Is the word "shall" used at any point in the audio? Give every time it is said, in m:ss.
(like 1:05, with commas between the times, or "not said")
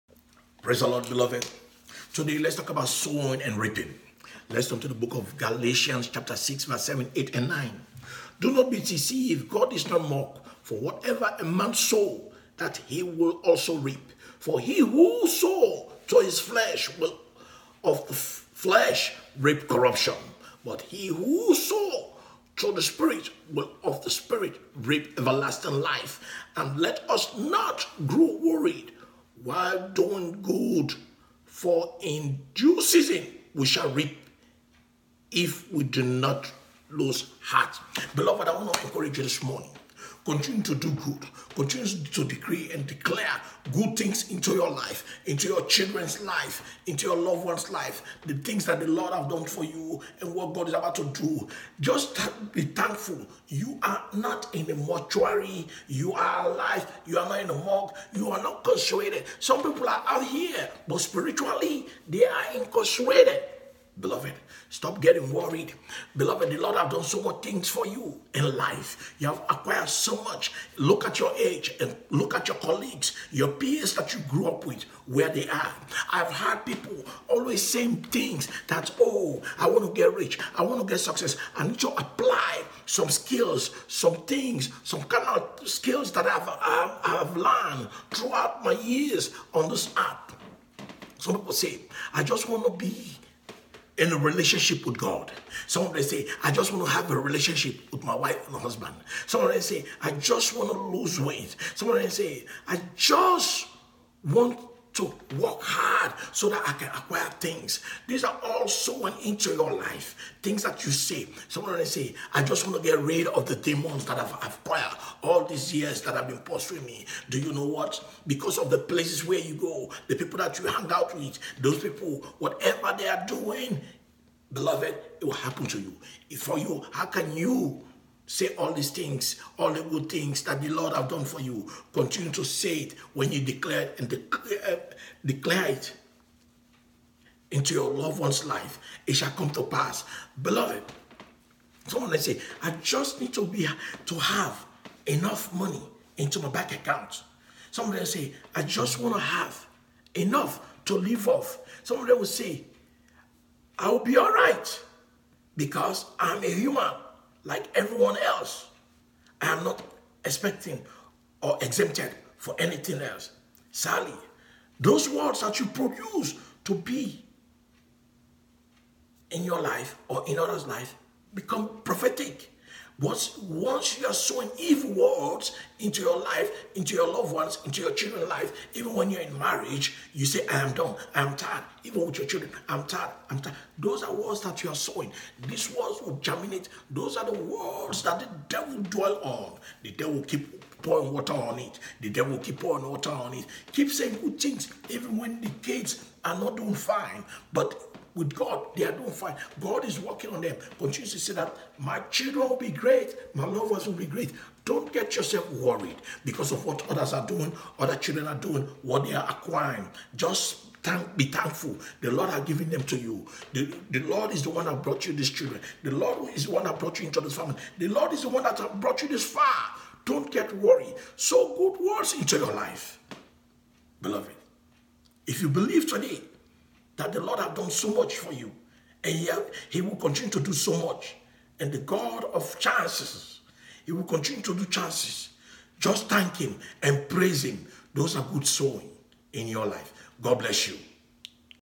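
0:33, 2:19.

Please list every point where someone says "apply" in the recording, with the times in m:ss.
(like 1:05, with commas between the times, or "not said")
1:21.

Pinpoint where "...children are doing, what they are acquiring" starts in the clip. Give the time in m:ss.
3:27.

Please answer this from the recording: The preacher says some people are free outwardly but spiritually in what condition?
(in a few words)
incarcerated.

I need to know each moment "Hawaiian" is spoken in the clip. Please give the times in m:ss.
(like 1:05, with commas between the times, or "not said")
not said.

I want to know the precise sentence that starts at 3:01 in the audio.
Even with your children, I'm tired, I'm tired.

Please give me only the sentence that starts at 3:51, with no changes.
And the God of chances, He will continue to do chances.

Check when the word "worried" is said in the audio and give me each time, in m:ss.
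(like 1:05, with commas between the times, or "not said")
0:28, 1:05, 3:25, 3:40.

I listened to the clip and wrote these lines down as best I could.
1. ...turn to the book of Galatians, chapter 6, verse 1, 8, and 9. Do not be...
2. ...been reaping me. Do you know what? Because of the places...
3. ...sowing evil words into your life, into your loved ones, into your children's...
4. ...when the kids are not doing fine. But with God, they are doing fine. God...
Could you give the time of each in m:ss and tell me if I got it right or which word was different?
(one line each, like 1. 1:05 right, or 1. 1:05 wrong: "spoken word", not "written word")
1. 0:04 wrong: "7", not "1"
2. 1:56 wrong: "pursuing", not "reaping"
3. 2:54 right
4. 3:15 right.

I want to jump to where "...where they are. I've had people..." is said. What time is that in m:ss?
1:15.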